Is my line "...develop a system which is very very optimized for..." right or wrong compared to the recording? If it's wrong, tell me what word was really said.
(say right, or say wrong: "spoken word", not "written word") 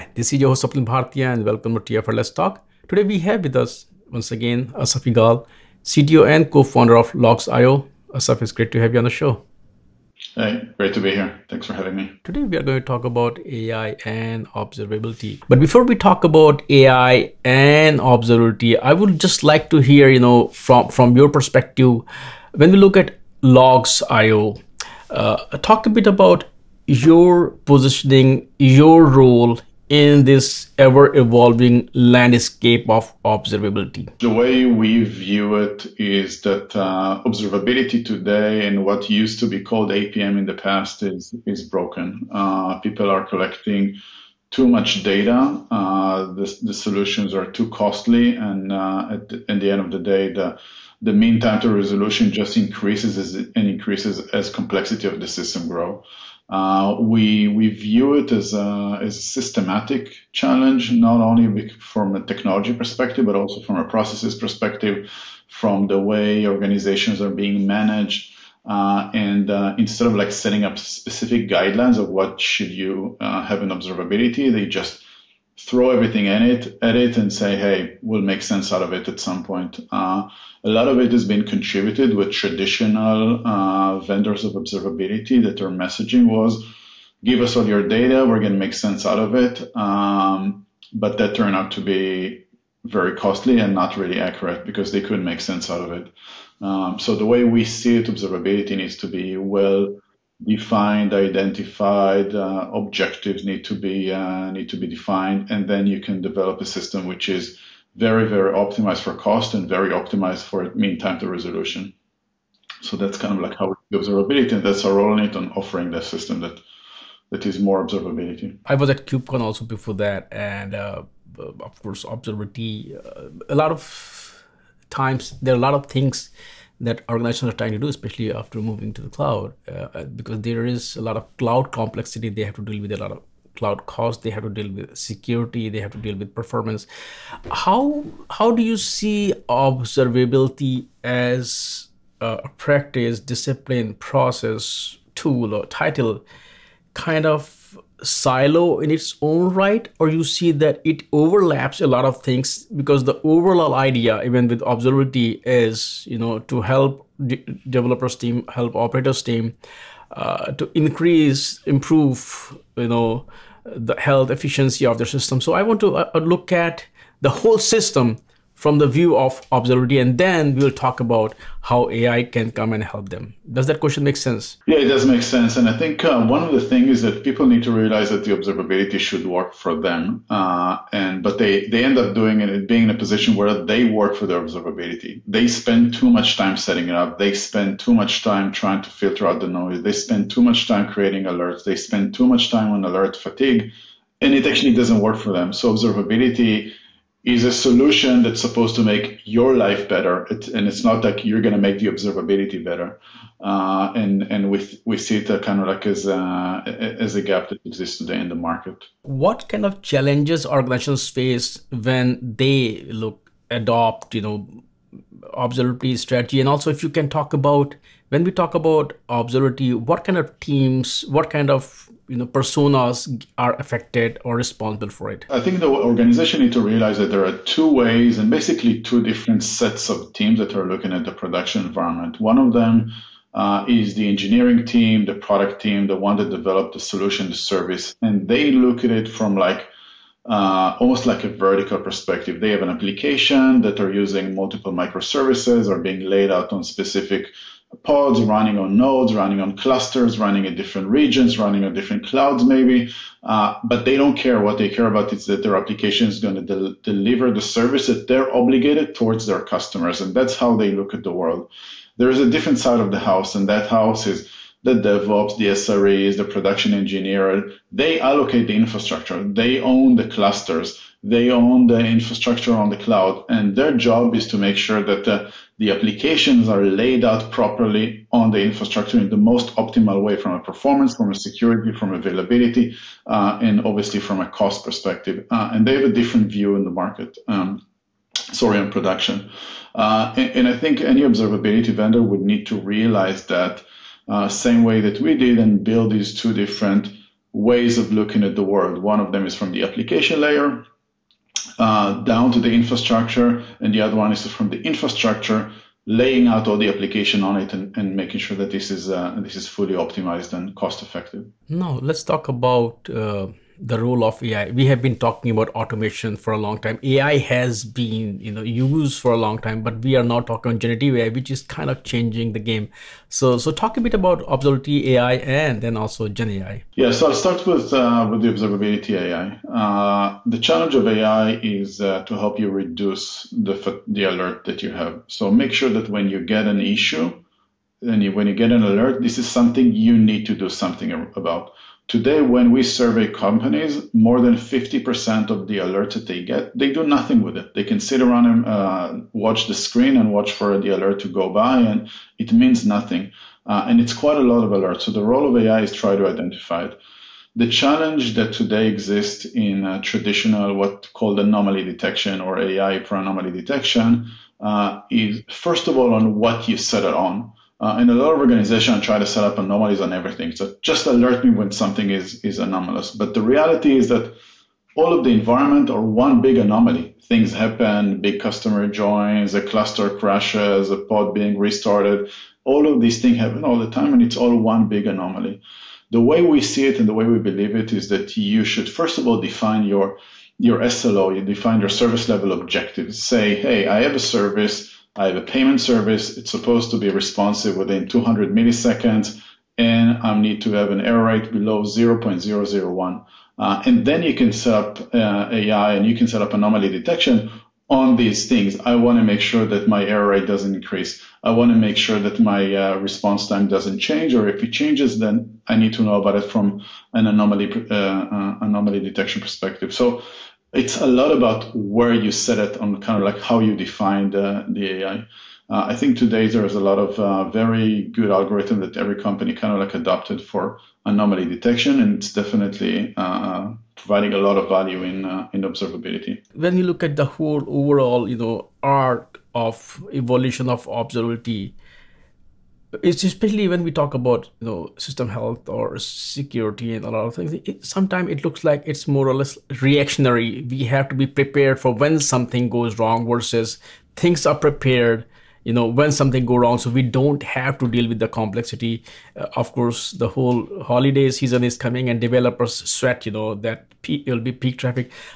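right.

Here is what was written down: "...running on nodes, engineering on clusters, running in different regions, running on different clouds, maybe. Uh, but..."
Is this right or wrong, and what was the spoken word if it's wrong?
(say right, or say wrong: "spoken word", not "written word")
wrong: "running", not "engineering".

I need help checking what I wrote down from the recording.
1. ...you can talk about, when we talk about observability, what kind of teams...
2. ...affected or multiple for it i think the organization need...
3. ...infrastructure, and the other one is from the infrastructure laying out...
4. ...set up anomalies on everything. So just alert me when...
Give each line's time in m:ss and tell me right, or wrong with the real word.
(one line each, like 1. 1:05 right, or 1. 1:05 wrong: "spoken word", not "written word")
1. 3:36 right
2. 3:43 wrong: "responsible", not "multiple"
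3. 5:02 right
4. 6:09 right.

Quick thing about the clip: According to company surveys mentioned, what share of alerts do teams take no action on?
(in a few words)
More than 50%.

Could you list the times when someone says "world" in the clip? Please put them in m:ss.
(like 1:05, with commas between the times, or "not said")
4:21, 4:58.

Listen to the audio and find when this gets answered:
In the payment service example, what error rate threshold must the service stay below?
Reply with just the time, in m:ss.
6:41.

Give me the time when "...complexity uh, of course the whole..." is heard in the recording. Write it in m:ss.
7:38.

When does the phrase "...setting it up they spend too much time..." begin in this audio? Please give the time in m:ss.
3:06.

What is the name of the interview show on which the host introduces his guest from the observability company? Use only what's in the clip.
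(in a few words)
TFLS Talk.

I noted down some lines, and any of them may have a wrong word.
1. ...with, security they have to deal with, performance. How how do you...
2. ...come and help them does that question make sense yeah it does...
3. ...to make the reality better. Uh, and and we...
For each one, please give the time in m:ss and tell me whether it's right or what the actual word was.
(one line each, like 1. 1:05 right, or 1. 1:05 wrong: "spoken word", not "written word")
1. 2:14 right
2. 2:52 right
3. 3:21 wrong: "observability", not "reality".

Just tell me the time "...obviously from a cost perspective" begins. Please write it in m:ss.
4:43.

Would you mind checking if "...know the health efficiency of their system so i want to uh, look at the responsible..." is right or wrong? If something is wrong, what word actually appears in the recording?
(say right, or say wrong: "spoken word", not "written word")
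wrong: "whole", not "responsible".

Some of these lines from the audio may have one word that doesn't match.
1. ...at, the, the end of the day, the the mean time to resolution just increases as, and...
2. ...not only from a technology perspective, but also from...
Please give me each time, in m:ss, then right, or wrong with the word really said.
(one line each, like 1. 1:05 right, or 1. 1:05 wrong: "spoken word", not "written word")
1. 0:49 right
2. 1:00 right.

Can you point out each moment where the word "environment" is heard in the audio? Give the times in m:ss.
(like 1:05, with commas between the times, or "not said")
3:51, 6:15.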